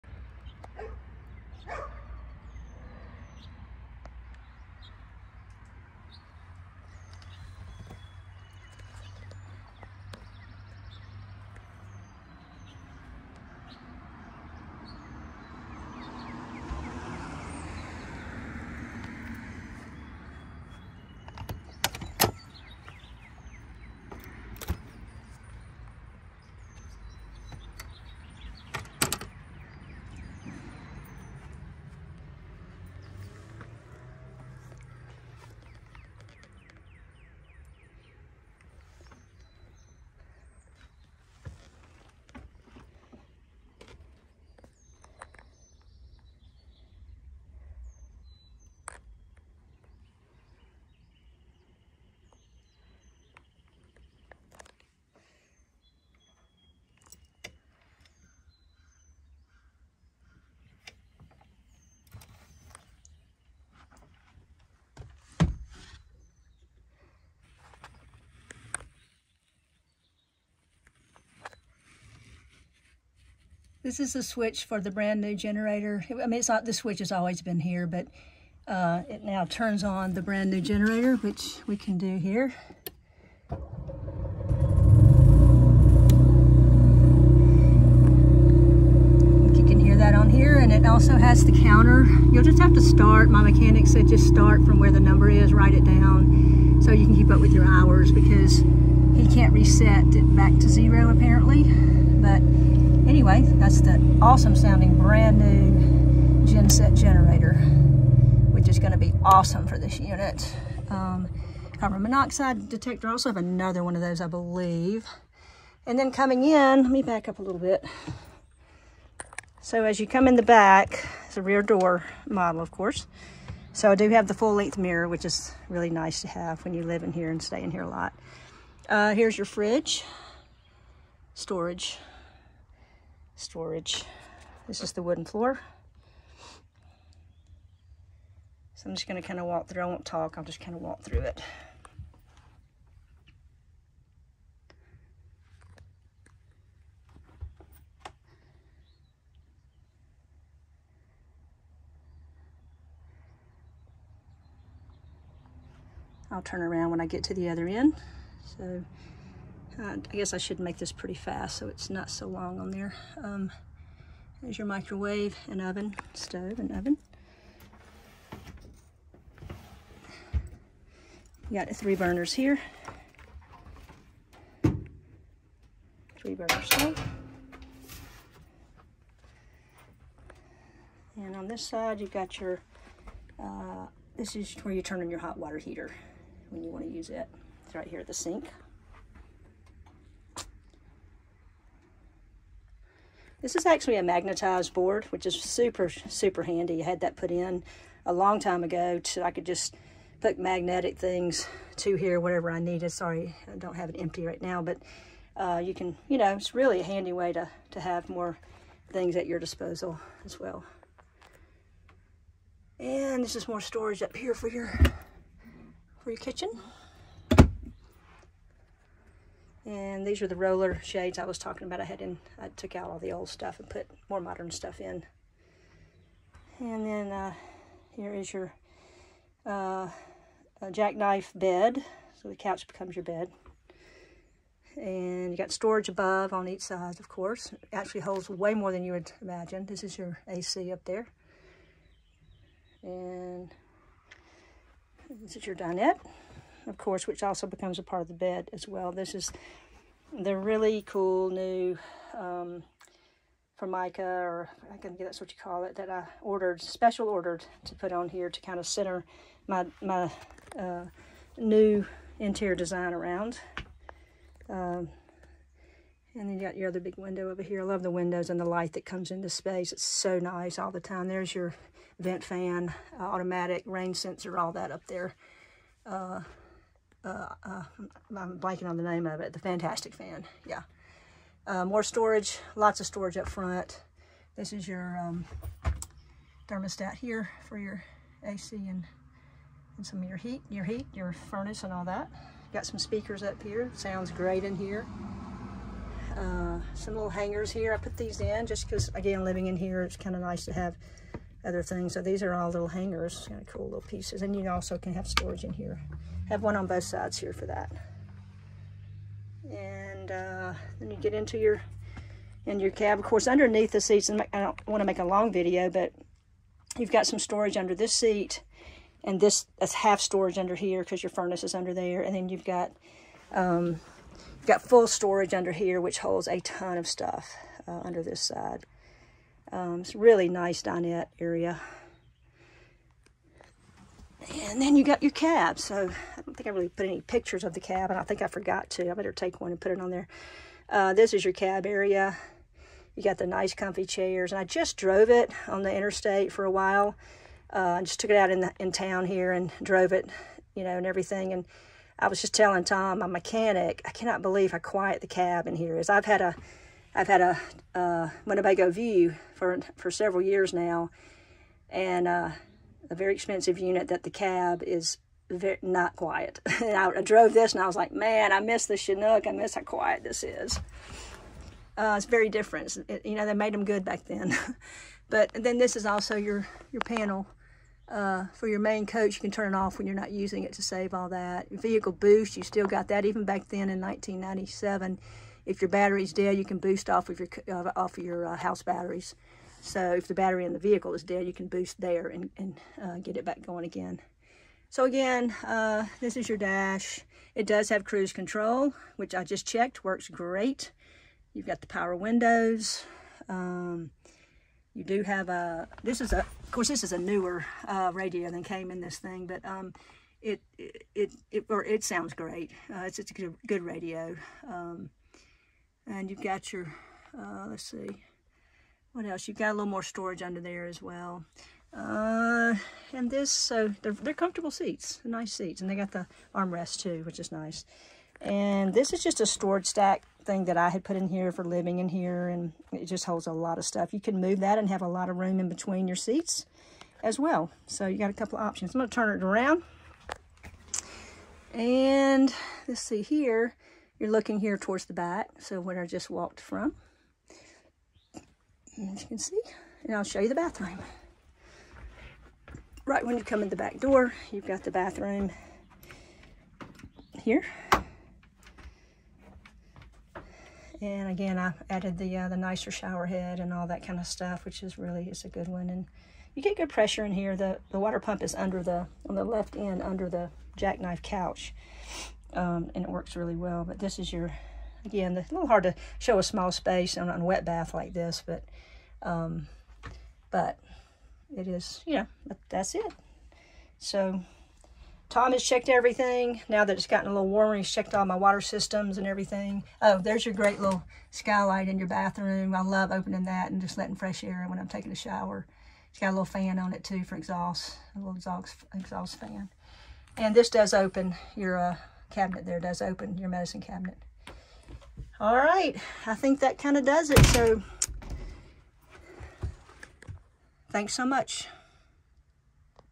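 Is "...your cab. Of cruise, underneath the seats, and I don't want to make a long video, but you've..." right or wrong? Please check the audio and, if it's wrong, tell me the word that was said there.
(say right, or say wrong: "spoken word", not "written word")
wrong: "course", not "cruise".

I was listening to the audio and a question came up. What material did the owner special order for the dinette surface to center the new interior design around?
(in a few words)
Formica.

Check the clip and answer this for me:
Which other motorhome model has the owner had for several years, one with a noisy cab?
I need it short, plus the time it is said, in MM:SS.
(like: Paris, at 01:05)
Winnebago View, at 05:58.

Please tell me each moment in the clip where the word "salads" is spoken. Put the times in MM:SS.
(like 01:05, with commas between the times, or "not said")
not said.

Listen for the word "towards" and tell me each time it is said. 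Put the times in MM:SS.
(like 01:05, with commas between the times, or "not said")
07:24.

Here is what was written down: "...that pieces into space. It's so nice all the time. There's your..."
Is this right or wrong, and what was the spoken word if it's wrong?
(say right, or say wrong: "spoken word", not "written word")
wrong: "comes", not "pieces".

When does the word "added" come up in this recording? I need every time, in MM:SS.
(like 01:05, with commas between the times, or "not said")
07:41.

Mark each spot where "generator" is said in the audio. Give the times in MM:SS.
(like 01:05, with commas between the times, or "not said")
01:15, 01:20, 01:46.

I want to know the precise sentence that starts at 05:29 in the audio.
Um, it's really nice dinette area.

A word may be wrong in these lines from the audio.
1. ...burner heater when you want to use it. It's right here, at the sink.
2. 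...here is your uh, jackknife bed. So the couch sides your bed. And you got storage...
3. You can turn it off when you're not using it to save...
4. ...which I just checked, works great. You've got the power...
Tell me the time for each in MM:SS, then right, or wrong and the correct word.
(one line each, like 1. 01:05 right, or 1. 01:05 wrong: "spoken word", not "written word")
1. 03:05 wrong: "water", not "burner"
2. 03:47 wrong: "becomes", not "sides"
3. 06:19 right
4. 06:38 right.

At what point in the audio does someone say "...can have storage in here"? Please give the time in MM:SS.
05:04.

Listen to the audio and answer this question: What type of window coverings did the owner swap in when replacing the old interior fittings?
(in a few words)
Roller shades.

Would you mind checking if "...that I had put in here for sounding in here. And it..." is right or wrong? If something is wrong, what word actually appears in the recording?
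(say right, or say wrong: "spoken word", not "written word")
wrong: "living", not "sounding".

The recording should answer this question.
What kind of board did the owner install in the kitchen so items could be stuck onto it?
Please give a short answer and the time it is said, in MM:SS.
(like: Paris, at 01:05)
Magnetized board, at 03:14.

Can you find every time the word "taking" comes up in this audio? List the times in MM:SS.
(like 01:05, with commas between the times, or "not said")
08:14.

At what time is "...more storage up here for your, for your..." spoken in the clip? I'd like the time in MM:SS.
03:33.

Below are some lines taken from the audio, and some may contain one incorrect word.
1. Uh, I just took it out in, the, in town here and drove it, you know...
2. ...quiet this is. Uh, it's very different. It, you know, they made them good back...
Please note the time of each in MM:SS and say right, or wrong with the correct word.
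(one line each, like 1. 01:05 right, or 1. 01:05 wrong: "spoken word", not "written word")
1. 05:47 right
2. 06:09 right.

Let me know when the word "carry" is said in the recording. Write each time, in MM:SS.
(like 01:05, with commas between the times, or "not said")
not said.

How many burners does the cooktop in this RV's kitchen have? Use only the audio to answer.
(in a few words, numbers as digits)
3.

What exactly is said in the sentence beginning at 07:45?
And you get good pressure in here.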